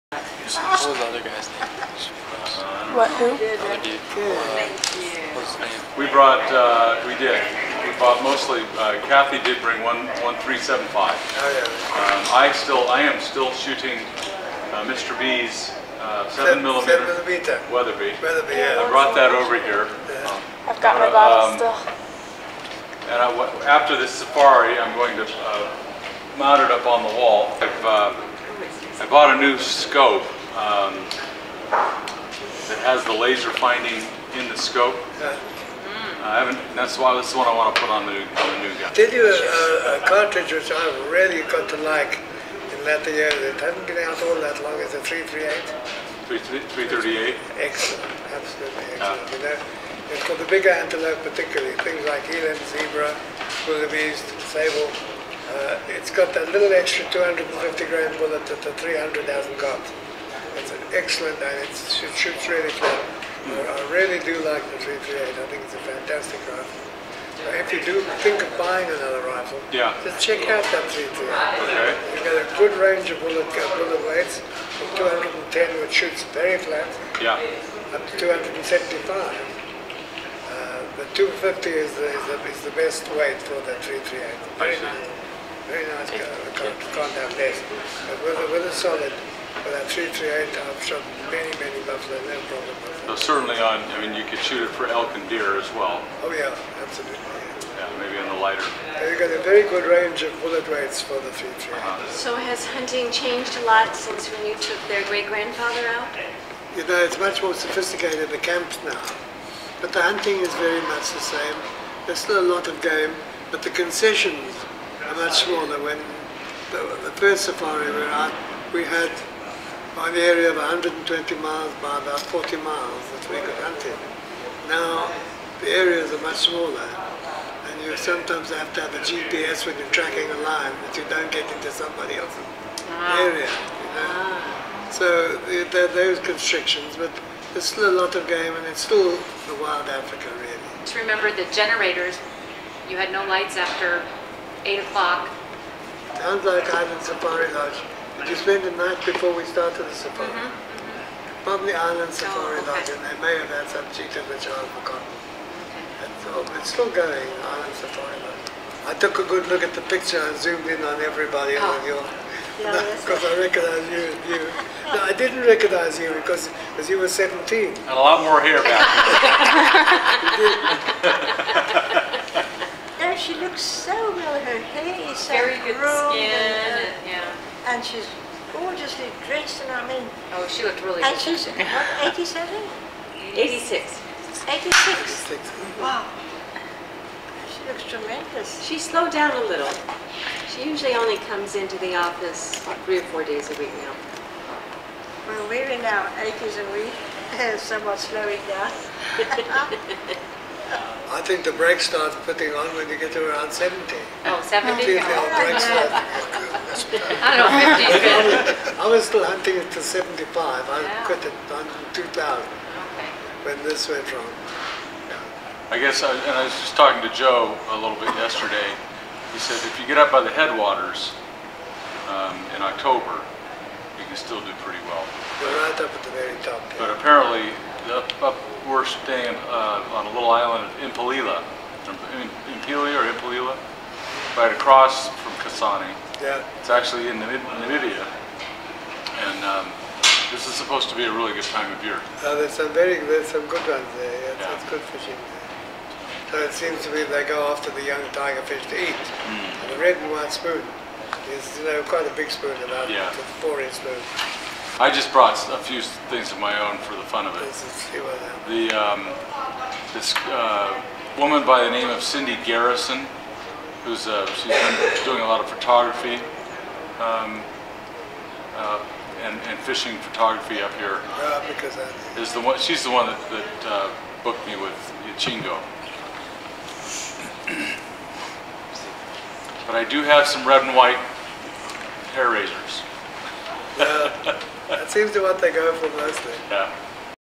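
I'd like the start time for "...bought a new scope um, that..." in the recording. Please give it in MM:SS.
00:29.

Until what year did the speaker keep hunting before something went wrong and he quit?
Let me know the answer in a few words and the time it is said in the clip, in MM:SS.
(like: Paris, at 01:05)
2000, at 03:31.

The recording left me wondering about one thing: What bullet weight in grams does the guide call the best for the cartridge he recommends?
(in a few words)
250.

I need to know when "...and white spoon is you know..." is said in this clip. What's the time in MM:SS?
04:09.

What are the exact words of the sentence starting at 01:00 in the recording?
It's an excellent, and it's, it shoots really well.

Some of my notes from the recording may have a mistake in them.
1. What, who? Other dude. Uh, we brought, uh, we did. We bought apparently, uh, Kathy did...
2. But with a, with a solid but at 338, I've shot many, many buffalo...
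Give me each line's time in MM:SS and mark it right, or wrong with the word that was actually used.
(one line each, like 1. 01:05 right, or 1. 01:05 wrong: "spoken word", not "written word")
1. 00:02 wrong: "mostly", not "apparently"
2. 01:28 right.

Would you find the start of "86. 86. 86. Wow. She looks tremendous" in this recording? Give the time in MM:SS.
03:03.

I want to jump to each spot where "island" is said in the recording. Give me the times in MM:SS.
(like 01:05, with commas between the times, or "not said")
02:26, 02:31, 02:37, 03:50.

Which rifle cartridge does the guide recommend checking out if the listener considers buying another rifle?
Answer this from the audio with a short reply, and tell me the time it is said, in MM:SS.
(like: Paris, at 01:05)
338, at 00:44.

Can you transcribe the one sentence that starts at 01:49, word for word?
But the hunting is very much the same.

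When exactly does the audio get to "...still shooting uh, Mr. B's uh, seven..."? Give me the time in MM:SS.
00:13.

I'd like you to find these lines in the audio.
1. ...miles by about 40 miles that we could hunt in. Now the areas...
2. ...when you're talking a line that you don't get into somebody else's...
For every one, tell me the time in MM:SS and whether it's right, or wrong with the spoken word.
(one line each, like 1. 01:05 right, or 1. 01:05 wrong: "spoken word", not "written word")
1. 02:01 right
2. 02:09 wrong: "tracking", not "talking".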